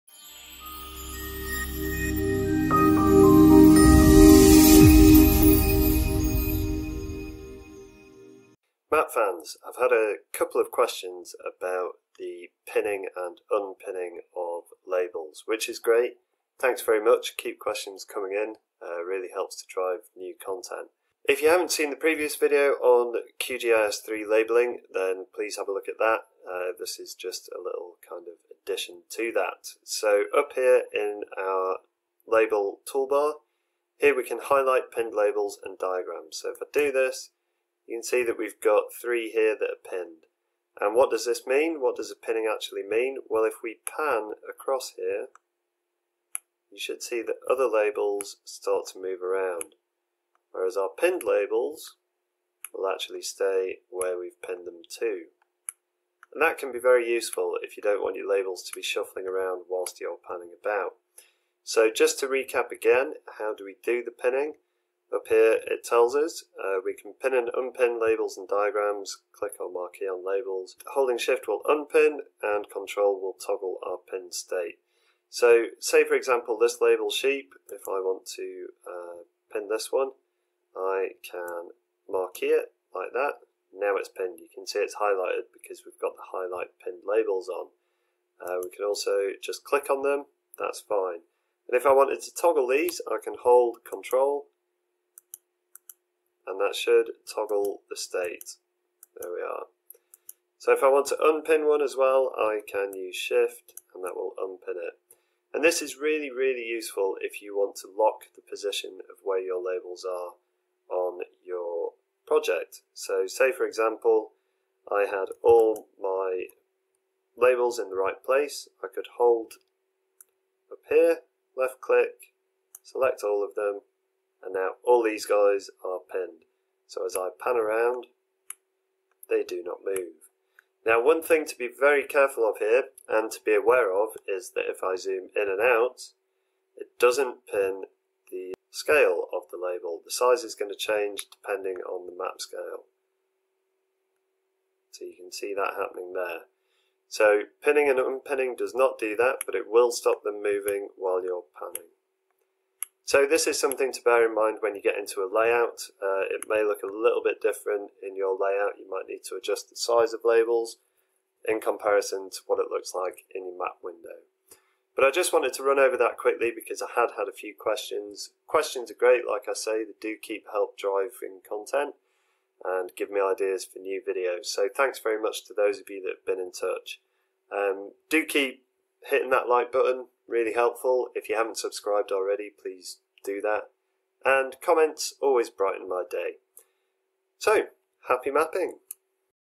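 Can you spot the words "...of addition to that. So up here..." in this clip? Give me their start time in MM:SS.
00:28.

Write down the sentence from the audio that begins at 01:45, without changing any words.
And this is really, really useful if you want to lock the position of where your labels are on your project.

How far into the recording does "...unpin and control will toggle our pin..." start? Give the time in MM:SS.
01:11.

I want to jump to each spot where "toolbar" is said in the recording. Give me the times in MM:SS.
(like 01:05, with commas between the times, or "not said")
00:32.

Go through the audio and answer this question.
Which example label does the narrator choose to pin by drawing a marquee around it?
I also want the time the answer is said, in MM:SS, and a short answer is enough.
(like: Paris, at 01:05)
Sheep, at 01:17.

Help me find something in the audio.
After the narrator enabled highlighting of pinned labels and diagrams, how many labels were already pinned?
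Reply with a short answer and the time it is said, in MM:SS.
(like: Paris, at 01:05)
3, at 00:39.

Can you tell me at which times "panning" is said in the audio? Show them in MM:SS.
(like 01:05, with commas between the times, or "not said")
01:00, 02:31.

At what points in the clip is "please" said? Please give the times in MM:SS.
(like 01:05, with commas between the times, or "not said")
00:25, 03:02.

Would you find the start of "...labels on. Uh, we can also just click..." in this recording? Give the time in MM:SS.
01:27.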